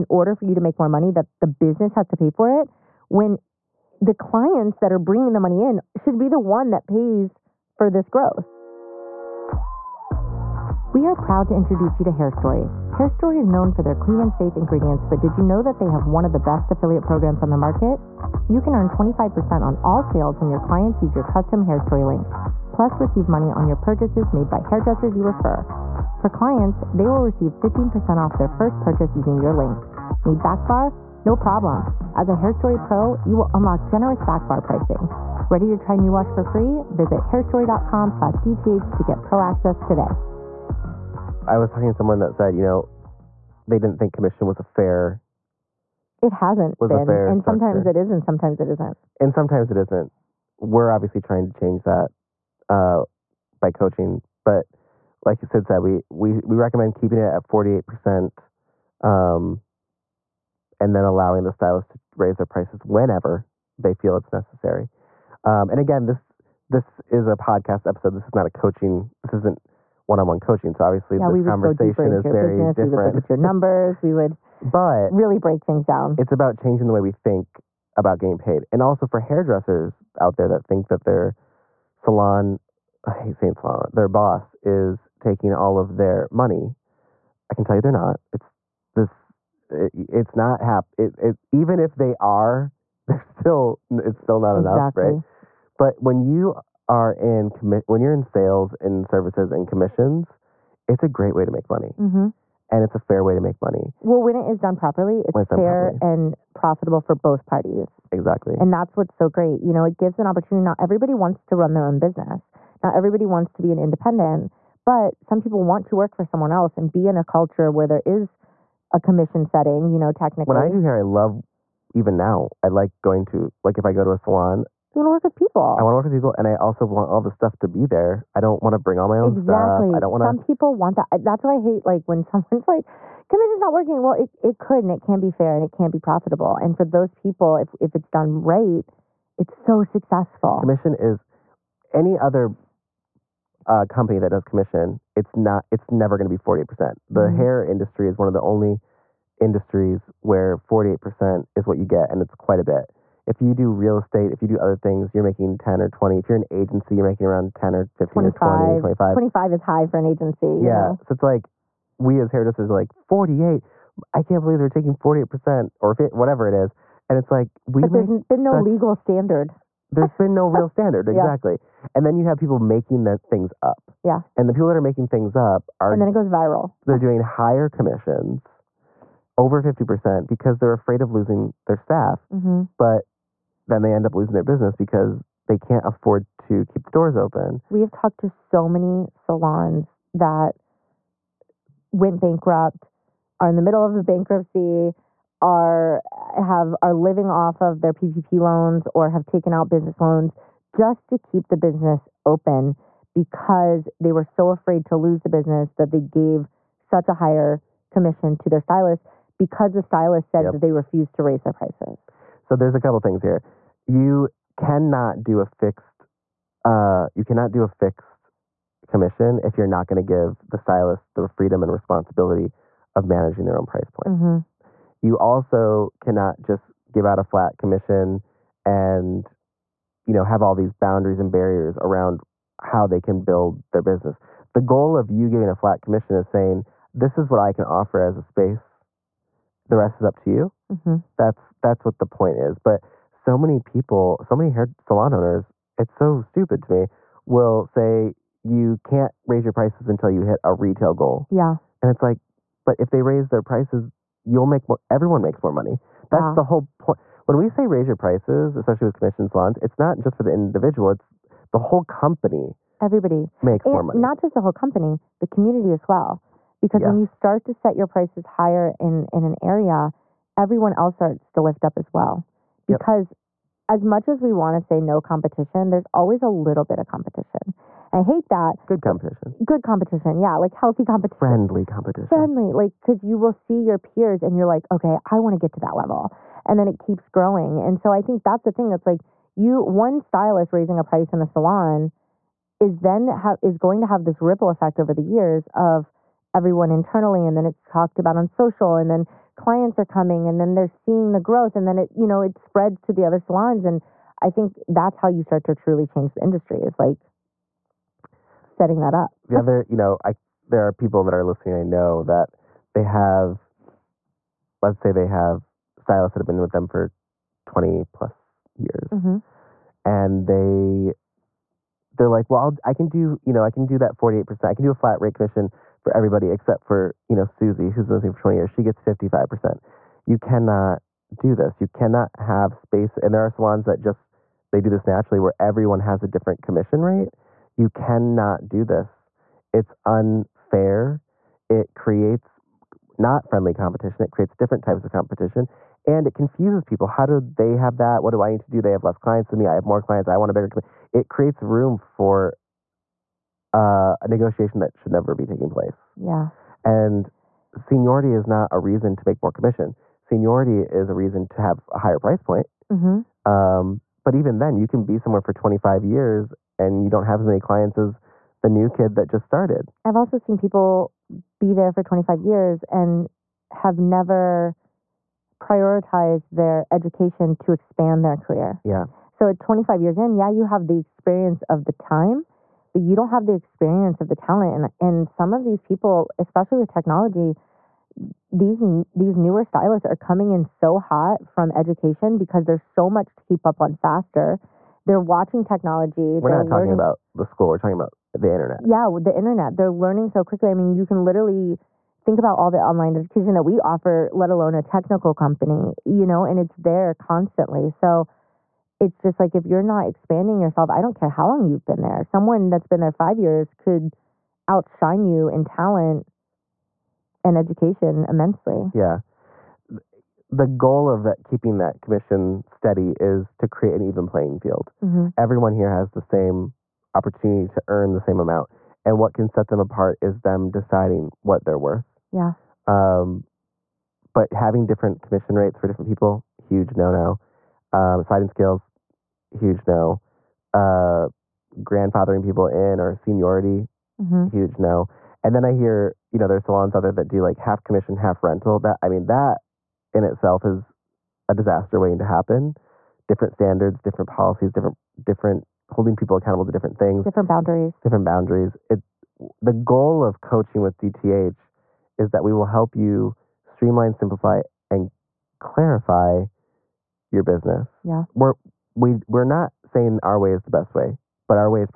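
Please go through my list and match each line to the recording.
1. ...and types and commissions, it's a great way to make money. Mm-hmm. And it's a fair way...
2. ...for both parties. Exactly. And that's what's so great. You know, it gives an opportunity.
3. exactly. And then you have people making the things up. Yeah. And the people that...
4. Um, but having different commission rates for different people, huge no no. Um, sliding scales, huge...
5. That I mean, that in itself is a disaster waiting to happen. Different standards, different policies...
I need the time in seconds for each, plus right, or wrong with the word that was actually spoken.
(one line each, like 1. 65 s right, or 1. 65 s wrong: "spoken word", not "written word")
1. 98 s wrong: "services", not "types"
2. 107 s right
3. 171 s right
4. 432 s right
5. 448 s right.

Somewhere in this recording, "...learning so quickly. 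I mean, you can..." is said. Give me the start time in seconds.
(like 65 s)
399 s.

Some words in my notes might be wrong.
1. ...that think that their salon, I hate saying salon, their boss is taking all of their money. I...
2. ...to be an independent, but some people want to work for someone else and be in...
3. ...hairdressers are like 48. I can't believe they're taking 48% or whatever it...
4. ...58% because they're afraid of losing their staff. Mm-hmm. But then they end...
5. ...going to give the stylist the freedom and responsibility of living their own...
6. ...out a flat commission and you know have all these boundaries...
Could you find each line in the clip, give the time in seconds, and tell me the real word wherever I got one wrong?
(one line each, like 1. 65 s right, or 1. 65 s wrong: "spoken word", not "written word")
1. 80 s right
2. 113 s right
3. 162 s right
4. 179 s wrong: "50", not "58"
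5. 219 s wrong: "managing", not "living"
6. 227 s right.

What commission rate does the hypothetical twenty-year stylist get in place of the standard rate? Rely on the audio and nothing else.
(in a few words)
55%.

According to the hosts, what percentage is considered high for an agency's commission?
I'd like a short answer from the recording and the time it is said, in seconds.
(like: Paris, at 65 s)
25%, at 159 s.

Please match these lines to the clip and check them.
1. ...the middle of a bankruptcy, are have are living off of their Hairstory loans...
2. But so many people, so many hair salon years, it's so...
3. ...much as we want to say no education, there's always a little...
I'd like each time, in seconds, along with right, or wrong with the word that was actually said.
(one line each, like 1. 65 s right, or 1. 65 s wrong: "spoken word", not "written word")
1. 193 s wrong: "PPP", not "Hairstory"
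2. 242 s wrong: "owners", not "years"
3. 273 s wrong: "competition", not "education".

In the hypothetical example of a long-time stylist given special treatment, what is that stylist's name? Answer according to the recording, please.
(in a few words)
Susie.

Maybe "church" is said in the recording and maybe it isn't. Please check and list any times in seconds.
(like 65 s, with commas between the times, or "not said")
not said.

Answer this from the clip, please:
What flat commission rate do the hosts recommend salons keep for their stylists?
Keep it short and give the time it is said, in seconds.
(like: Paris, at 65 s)
48%, at 57 s.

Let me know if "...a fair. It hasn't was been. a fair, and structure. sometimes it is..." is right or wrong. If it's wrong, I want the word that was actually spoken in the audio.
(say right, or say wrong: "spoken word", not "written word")
right.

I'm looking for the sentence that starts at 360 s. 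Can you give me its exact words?
Seniority is a reason to have a higher price point.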